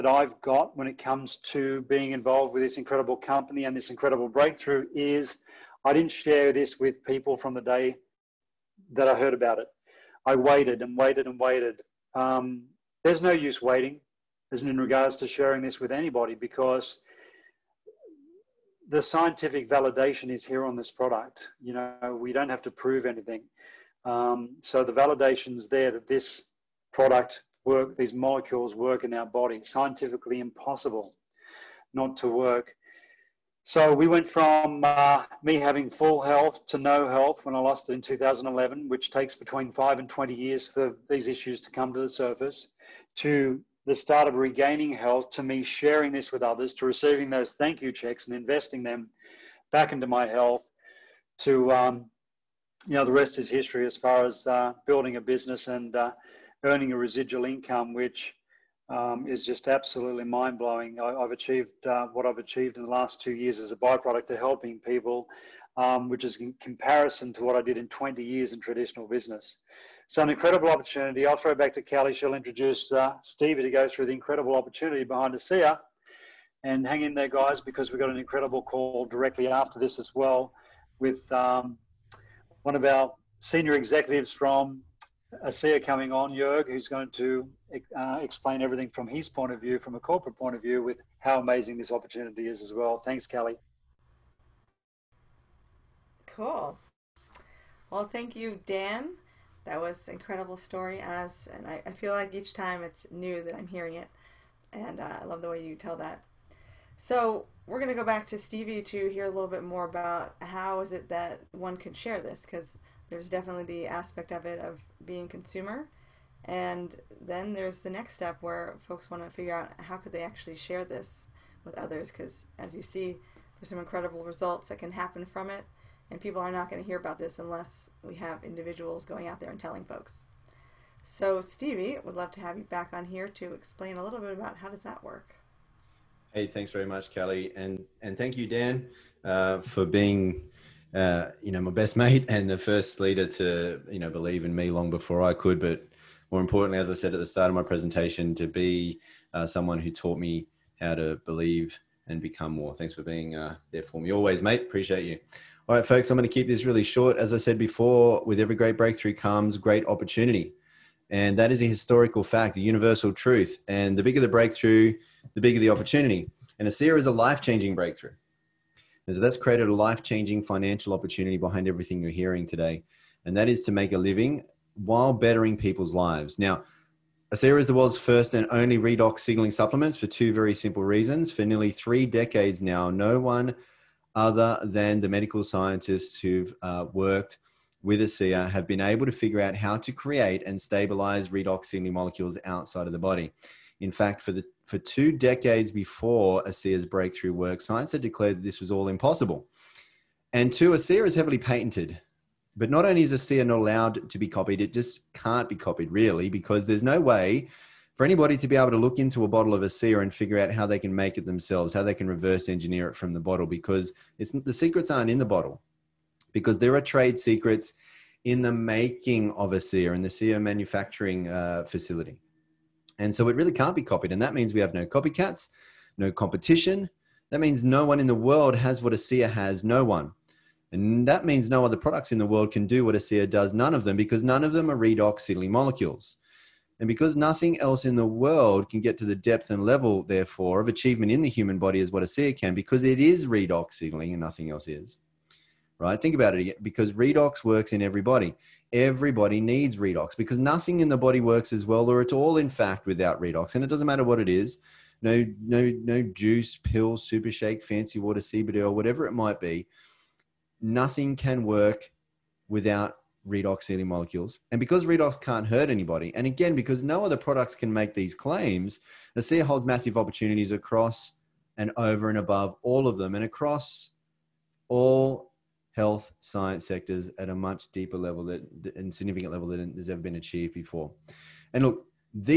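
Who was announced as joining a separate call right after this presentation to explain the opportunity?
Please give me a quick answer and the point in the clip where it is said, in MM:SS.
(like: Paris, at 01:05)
Jörg, at 01:26.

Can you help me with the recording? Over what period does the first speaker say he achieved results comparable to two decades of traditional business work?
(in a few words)
the last 2 years.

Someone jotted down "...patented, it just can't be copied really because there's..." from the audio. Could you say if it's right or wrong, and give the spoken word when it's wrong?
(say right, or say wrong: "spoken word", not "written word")
wrong: "copied", not "patented".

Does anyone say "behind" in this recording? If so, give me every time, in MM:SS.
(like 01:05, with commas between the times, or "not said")
01:15, 02:51.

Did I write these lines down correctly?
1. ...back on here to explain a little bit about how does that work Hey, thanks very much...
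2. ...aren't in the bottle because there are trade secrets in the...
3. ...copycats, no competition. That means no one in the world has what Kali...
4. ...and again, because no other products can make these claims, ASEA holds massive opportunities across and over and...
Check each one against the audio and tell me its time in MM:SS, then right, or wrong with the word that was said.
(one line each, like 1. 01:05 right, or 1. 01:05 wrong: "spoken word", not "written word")
1. 02:12 right
2. 03:34 right
3. 03:44 wrong: "ASEA", not "Kali"
4. 04:26 right.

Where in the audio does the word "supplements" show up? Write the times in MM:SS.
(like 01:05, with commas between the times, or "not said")
02:59.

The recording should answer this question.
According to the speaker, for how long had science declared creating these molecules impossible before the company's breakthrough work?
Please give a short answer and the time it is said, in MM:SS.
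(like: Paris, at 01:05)
2 decades, at 03:14.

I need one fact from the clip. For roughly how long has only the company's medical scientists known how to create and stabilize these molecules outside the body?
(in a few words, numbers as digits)
nearly 3 decades.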